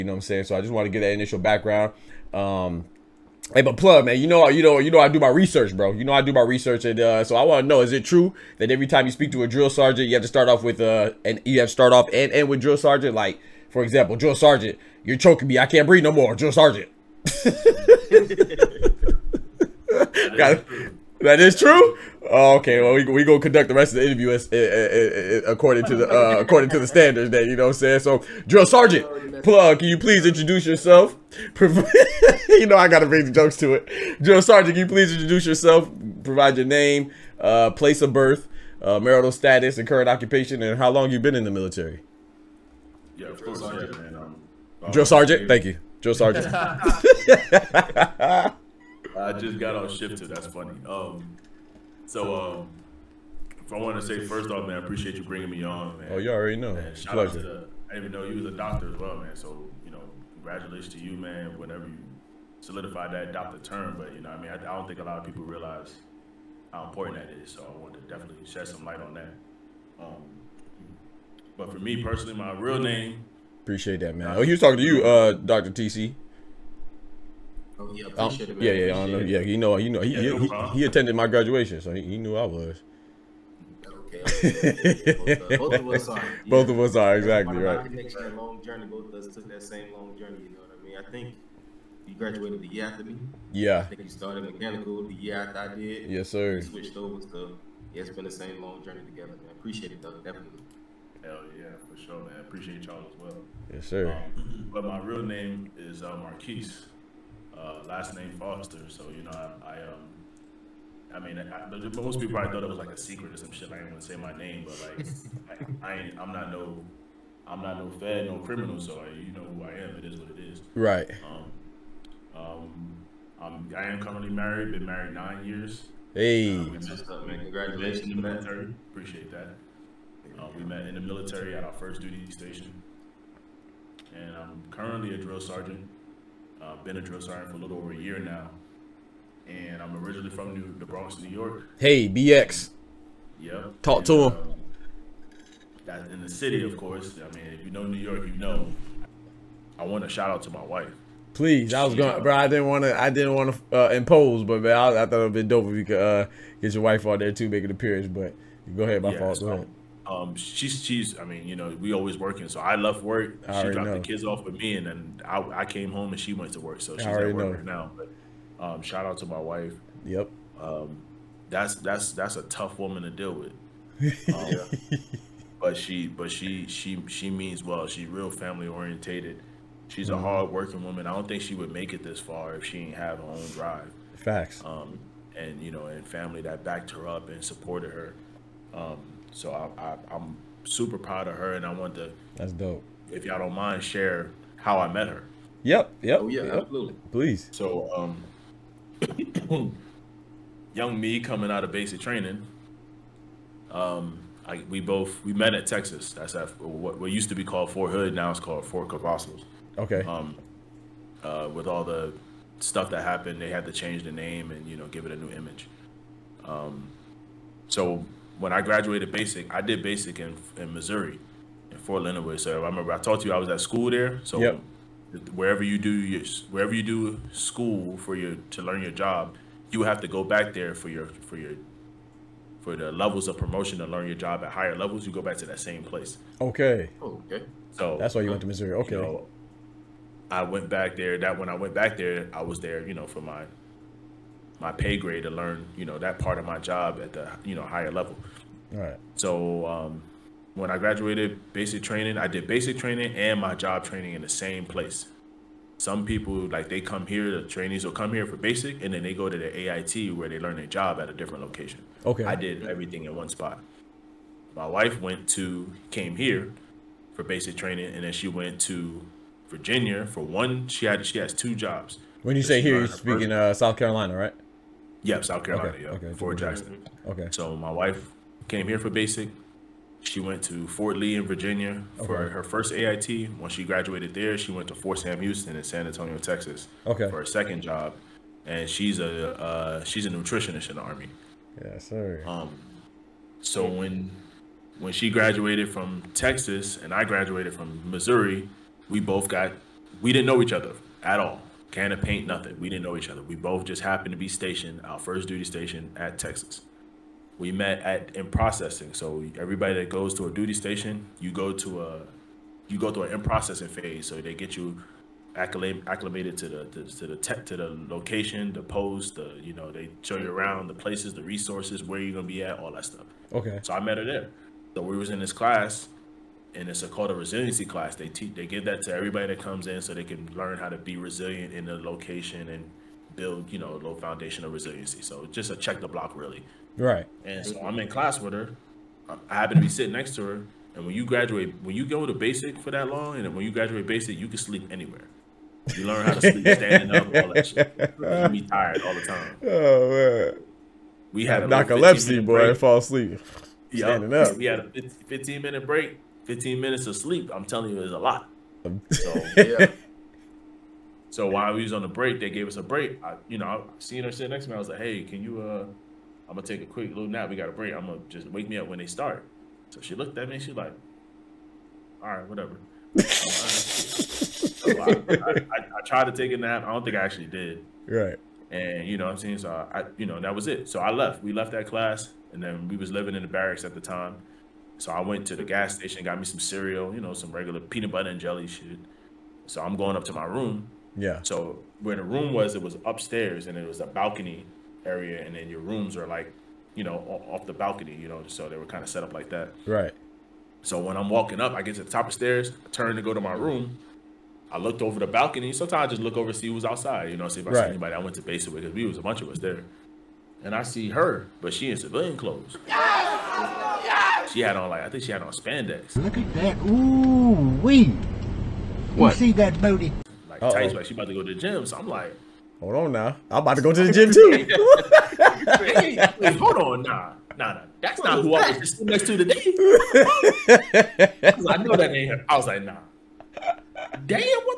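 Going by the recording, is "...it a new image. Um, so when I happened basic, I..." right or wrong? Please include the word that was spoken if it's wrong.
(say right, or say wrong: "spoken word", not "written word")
wrong: "graduated", not "happened".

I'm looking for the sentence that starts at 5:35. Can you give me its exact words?
So just a check the block really.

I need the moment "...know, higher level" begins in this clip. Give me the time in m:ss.
4:07.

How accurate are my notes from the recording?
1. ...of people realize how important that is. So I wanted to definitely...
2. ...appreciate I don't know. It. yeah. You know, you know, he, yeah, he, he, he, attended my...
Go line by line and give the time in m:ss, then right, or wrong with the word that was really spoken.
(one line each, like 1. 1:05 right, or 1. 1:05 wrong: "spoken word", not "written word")
1. 1:05 right
2. 1:18 right.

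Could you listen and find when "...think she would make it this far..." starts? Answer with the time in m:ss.
3:01.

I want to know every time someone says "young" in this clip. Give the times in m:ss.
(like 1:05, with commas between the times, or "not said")
3:20.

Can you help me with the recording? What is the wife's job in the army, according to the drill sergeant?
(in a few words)
Nutritionist.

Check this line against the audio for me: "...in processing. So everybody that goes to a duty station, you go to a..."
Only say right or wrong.
right.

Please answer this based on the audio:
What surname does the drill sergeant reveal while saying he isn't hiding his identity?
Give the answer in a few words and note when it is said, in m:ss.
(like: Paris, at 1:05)
Foster, at 1:48.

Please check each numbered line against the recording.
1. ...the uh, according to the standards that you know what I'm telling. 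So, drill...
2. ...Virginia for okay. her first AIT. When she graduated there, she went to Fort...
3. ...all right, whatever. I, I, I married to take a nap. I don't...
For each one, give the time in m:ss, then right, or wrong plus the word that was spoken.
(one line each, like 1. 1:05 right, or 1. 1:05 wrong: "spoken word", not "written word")
1. 0:25 wrong: "saying", not "telling"
2. 4:41 right
3. 6:12 wrong: "tried", not "married".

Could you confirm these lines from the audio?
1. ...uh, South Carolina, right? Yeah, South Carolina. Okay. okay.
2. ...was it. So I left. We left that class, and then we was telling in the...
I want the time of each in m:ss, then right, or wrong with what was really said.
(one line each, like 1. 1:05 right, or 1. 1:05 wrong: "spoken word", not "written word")
1. 4:33 right
2. 6:20 wrong: "living", not "telling".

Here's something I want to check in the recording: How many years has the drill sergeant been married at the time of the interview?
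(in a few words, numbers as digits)
9.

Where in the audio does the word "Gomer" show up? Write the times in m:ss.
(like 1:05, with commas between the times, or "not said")
not said.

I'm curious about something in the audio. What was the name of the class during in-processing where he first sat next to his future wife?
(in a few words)
Resiliency class.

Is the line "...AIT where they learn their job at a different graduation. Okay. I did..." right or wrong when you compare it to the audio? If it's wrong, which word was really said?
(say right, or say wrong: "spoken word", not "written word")
wrong: "location", not "graduation".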